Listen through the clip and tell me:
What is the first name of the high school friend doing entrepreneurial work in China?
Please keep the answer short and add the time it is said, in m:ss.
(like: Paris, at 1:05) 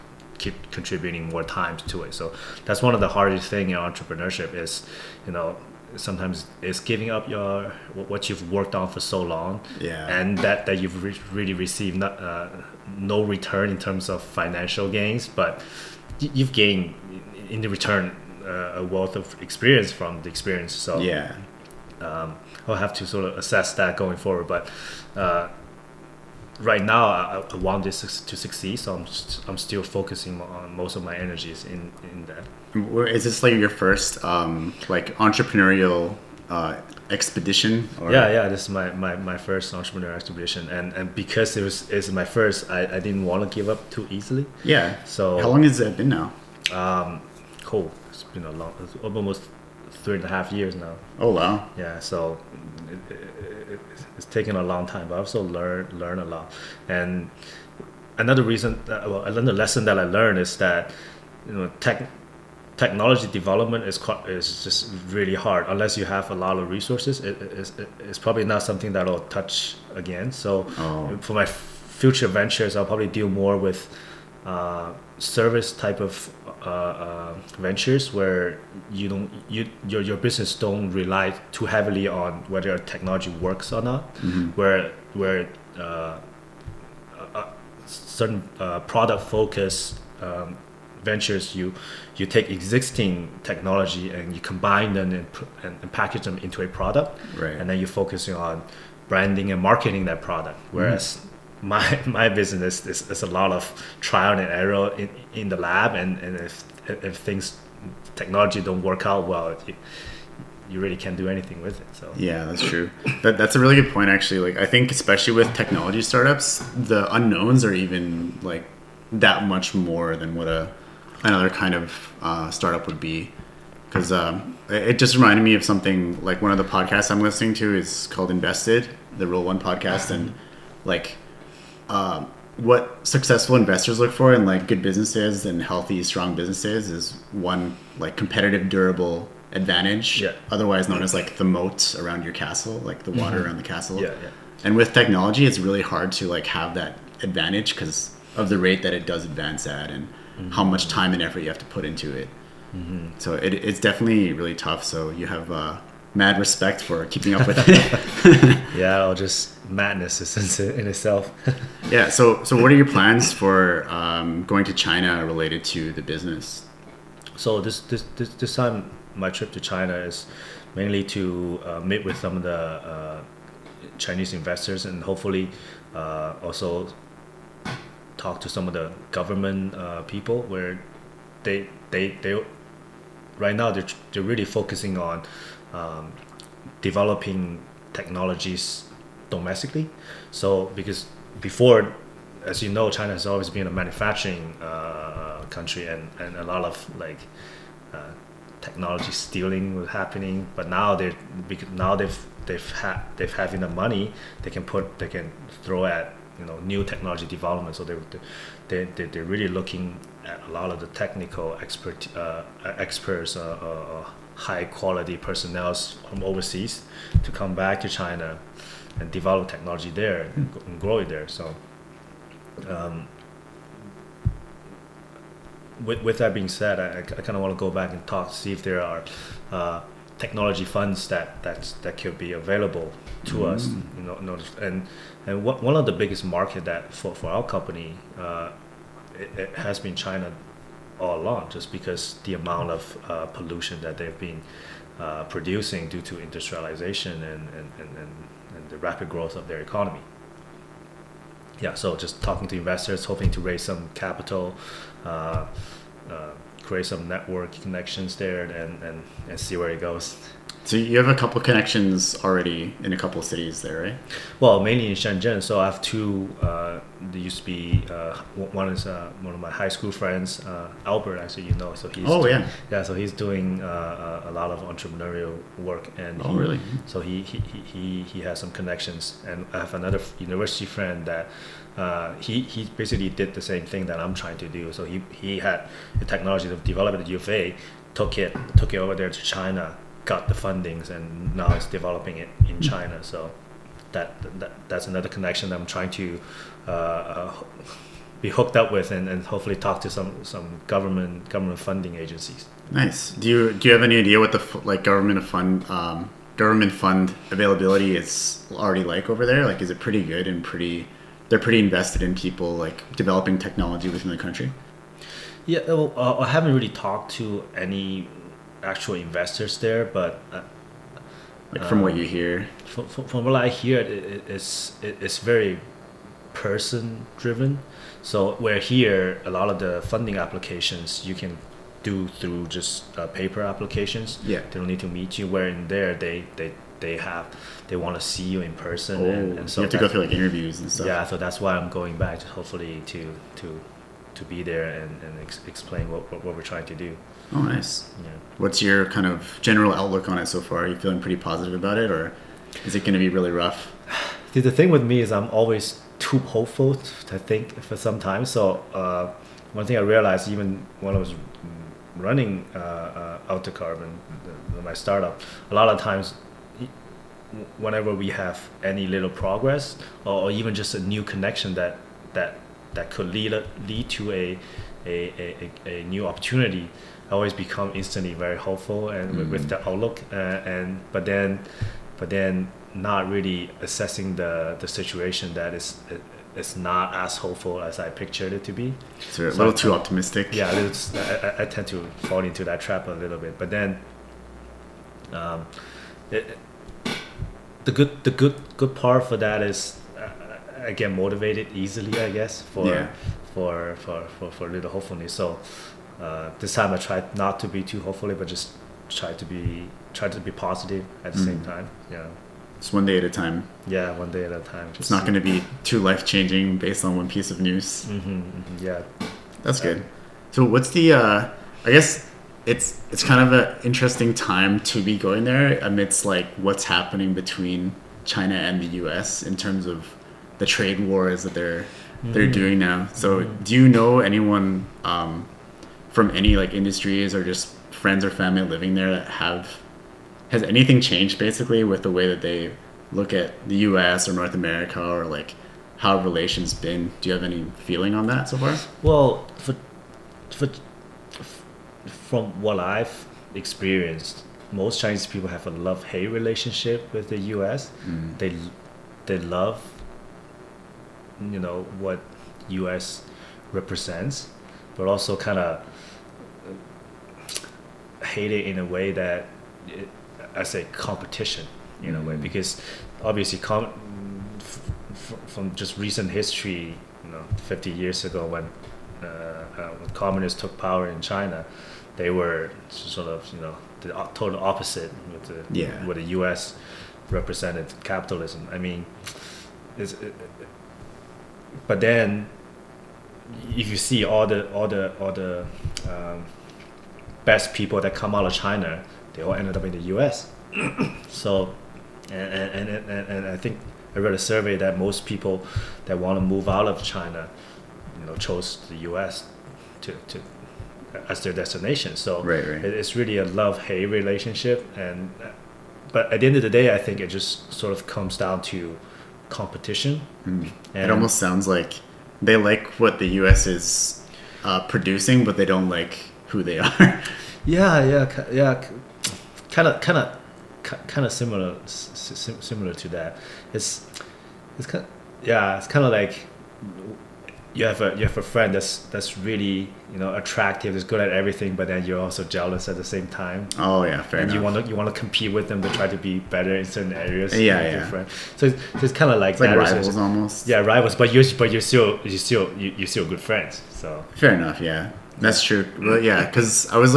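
Albert, at 4:30.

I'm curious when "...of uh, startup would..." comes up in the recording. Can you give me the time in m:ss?
2:01.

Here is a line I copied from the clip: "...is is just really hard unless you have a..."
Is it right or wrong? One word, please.
right.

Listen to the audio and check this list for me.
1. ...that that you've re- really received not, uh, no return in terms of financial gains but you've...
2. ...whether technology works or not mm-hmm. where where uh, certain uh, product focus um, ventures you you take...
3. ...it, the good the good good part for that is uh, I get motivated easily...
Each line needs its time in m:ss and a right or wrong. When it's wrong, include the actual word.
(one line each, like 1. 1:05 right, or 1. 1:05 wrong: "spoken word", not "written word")
1. 0:10 right
2. 1:22 right
3. 6:36 right.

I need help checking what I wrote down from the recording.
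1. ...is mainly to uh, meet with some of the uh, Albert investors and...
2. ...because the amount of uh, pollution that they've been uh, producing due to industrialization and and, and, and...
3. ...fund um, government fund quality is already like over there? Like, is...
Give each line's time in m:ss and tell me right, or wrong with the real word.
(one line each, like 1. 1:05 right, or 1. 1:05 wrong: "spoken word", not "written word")
1. 2:49 wrong: "Chinese", not "Albert"
2. 4:01 right
3. 5:05 wrong: "availability", not "quality".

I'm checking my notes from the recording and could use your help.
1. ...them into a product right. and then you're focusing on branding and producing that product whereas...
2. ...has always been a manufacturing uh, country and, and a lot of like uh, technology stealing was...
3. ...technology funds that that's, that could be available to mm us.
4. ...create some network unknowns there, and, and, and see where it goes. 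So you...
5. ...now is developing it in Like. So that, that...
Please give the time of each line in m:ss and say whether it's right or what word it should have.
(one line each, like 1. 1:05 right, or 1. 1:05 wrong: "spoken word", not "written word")
1. 1:36 wrong: "marketing", not "producing"
2. 3:13 right
3. 3:50 right
4. 4:16 wrong: "connections", not "unknowns"
5. 4:51 wrong: "China", not "Like".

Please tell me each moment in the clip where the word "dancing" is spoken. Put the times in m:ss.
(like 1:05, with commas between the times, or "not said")
not said.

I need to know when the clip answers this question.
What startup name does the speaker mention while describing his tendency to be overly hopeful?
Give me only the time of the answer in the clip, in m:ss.
6:03.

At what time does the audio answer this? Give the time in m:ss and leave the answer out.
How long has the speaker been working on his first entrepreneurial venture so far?
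0:49.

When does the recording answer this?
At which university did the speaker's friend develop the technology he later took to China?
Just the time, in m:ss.
4:47.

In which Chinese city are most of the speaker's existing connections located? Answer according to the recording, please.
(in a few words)
Shenzhen.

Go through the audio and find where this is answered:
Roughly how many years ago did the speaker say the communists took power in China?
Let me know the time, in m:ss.
7:57.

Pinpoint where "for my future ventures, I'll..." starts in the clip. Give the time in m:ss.
1:11.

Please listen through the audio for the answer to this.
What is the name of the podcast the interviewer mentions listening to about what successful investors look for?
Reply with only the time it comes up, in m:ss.
2:08.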